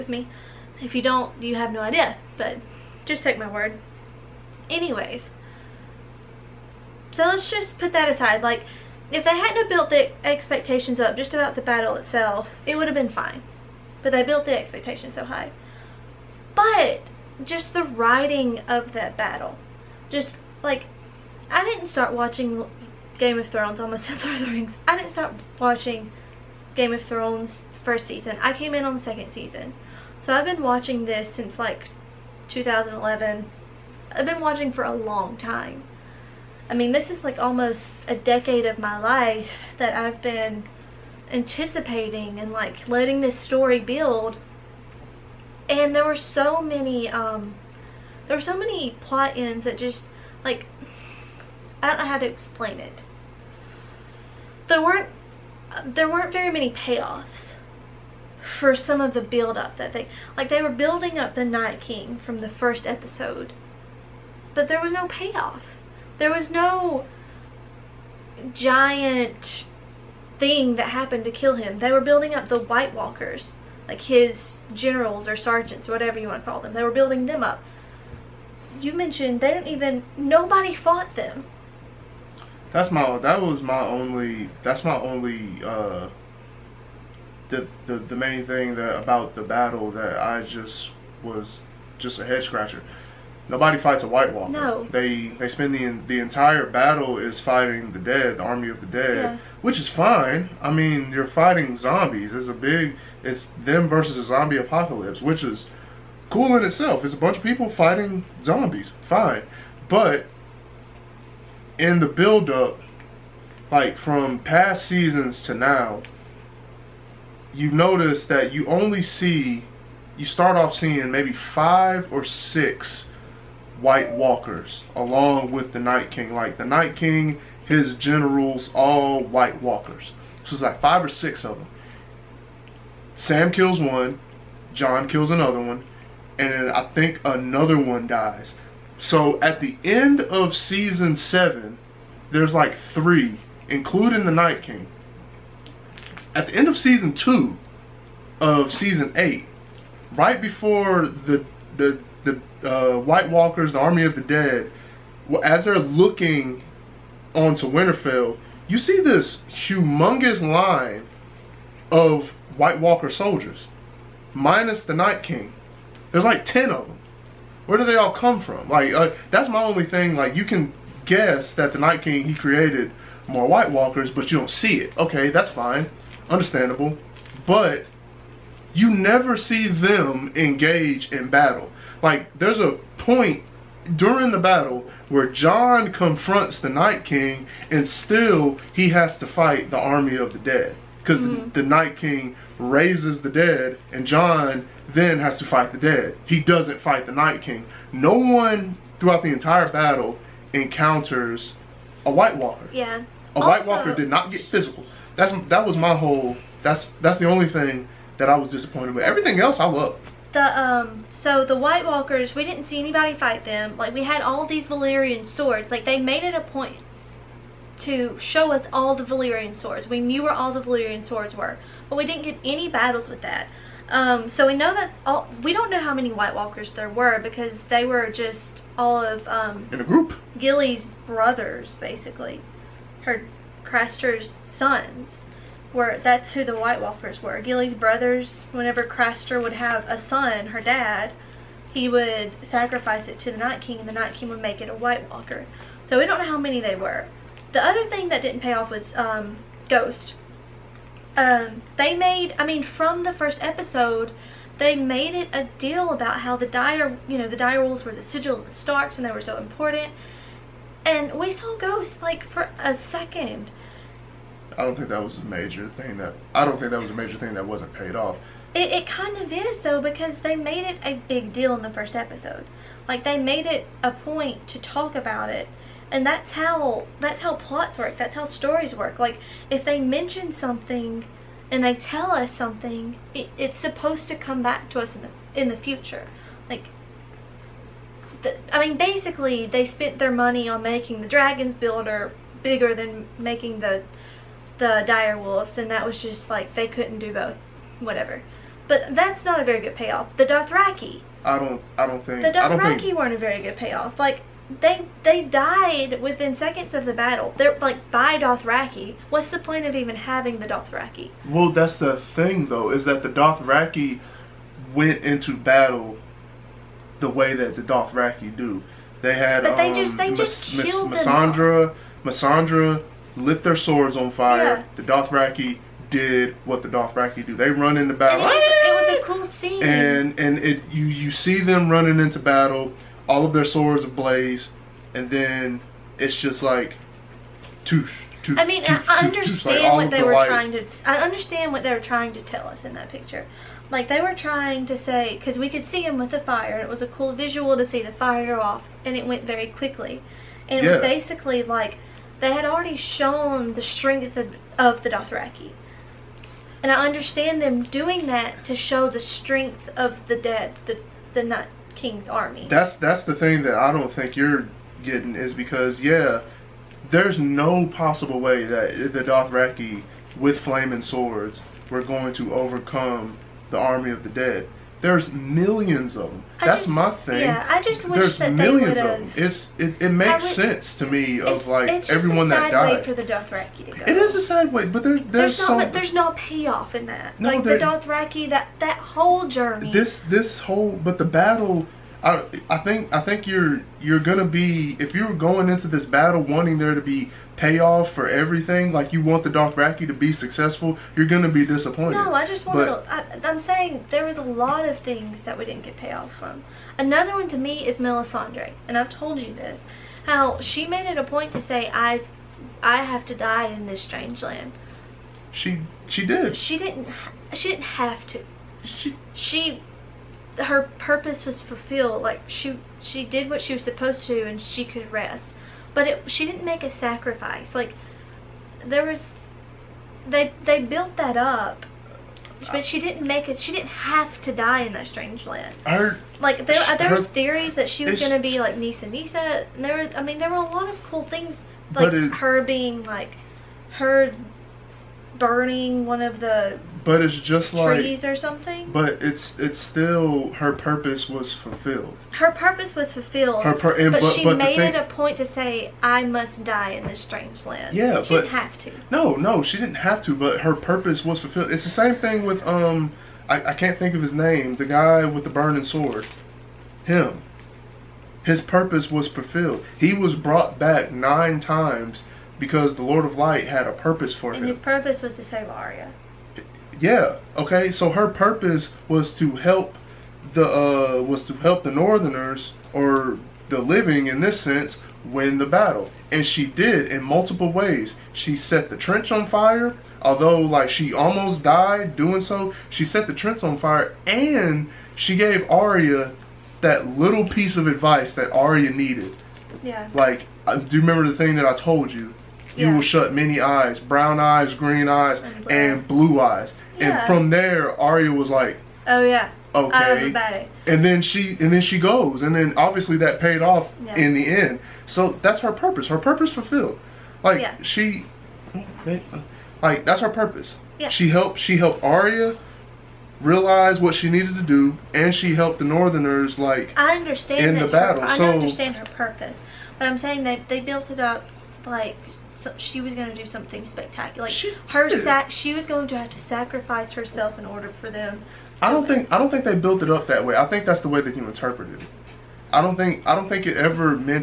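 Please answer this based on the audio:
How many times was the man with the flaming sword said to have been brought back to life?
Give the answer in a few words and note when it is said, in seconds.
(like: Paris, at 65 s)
nine, at 470 s.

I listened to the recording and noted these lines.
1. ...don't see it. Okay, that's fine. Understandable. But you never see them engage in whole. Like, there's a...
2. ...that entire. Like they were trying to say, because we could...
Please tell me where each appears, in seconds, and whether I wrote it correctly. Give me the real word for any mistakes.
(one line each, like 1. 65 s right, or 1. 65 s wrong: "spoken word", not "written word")
1. 174 s wrong: "battle", not "whole"
2. 342 s wrong: "picture", not "entire".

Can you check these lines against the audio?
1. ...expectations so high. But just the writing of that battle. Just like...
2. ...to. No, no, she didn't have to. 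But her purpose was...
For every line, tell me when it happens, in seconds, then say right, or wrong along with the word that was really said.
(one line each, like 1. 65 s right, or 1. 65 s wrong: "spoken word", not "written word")
1. 14 s right
2. 458 s right.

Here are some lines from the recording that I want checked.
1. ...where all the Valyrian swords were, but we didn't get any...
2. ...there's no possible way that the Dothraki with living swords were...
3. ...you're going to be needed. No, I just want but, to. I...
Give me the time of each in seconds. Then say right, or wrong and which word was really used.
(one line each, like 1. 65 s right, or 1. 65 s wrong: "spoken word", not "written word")
1. 220 s right
2. 366 s wrong: "flaming", not "living"
3. 400 s wrong: "disappointed", not "needed".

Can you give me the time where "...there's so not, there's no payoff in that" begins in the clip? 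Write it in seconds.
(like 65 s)
385 s.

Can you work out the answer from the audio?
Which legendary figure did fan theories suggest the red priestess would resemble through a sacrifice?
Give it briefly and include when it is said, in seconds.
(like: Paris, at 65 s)
Nissa Nissa, at 438 s.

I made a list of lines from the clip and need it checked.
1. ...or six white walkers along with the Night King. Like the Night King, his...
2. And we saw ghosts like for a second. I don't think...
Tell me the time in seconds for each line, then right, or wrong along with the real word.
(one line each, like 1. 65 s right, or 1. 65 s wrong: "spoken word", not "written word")
1. 122 s right
2. 260 s right.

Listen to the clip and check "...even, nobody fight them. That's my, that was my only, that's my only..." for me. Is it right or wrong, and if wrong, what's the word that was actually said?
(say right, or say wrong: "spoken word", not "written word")
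wrong: "fought", not "fight".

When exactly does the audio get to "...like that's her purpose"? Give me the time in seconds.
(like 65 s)
519 s.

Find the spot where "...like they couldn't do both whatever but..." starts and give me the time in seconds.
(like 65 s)
296 s.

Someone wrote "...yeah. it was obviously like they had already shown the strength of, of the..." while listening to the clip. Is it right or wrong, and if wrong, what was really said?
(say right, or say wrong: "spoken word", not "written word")
wrong: "basically", not "obviously".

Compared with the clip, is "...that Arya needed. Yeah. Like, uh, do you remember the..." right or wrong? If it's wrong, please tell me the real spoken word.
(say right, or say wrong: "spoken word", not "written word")
right.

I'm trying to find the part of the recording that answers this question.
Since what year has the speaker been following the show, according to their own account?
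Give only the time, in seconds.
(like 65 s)
32 s.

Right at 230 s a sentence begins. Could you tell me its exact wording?
Gilly's brothers, basically, her Craster's sons were that's who the White Walkers were.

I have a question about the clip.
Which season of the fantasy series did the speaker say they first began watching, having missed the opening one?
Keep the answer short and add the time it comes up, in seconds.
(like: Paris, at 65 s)
second season, at 29 s.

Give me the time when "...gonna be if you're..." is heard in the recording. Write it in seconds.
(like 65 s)
393 s.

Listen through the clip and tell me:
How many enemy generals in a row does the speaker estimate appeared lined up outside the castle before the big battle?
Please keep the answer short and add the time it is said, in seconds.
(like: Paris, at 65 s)
10, at 166 s.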